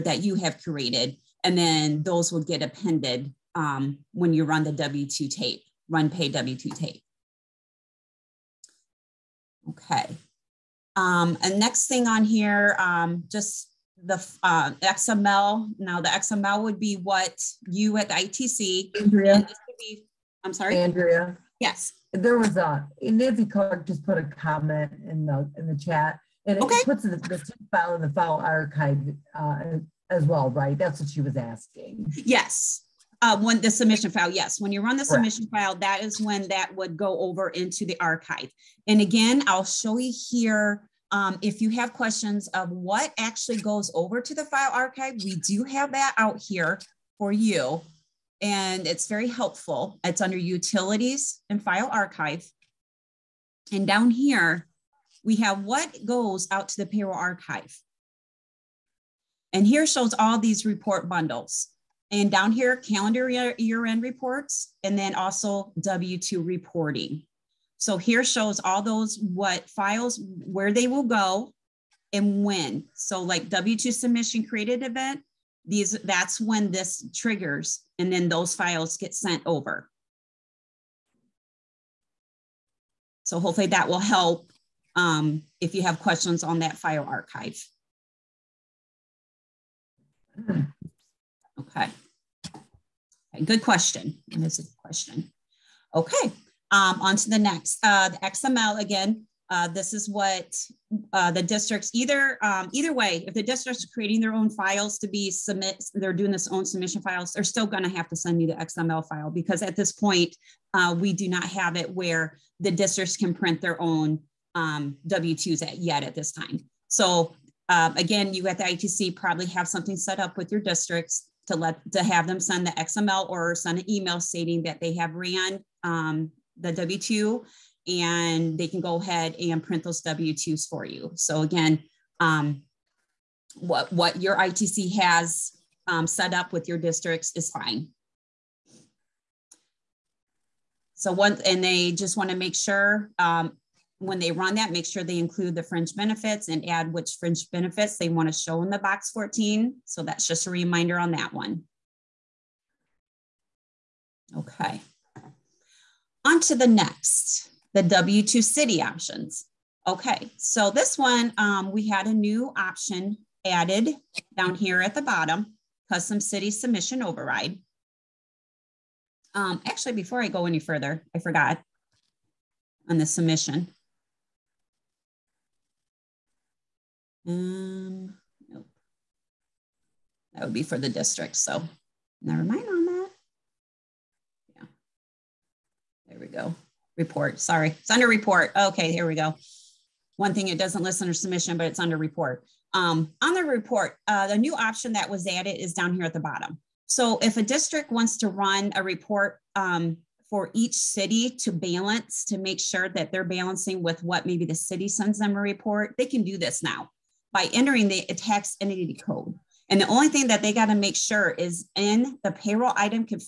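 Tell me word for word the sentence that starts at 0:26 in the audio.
it puts the, the file in the file archive uh, as well, right?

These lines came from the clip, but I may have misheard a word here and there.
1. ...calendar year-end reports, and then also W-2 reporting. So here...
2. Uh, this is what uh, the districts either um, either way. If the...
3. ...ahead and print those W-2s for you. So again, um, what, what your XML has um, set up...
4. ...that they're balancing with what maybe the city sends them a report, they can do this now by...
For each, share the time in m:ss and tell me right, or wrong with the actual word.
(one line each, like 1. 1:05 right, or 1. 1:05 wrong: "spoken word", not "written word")
1. 1:02 right
2. 1:39 right
3. 2:08 wrong: "ITC", not "XML"
4. 3:22 right.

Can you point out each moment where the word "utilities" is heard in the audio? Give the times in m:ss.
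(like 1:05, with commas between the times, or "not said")
0:50.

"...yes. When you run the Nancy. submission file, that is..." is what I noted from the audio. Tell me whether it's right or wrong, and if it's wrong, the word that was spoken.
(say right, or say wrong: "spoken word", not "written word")
wrong: "Correct", not "Nancy".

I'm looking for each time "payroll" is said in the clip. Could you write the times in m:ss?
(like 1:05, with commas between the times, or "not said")
0:56, 3:32.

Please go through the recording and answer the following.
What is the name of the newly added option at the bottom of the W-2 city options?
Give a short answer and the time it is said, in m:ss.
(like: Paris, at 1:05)
custom city submission override, at 2:45.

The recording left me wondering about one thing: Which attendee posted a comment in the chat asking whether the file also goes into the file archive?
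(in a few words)
Nancy Clark.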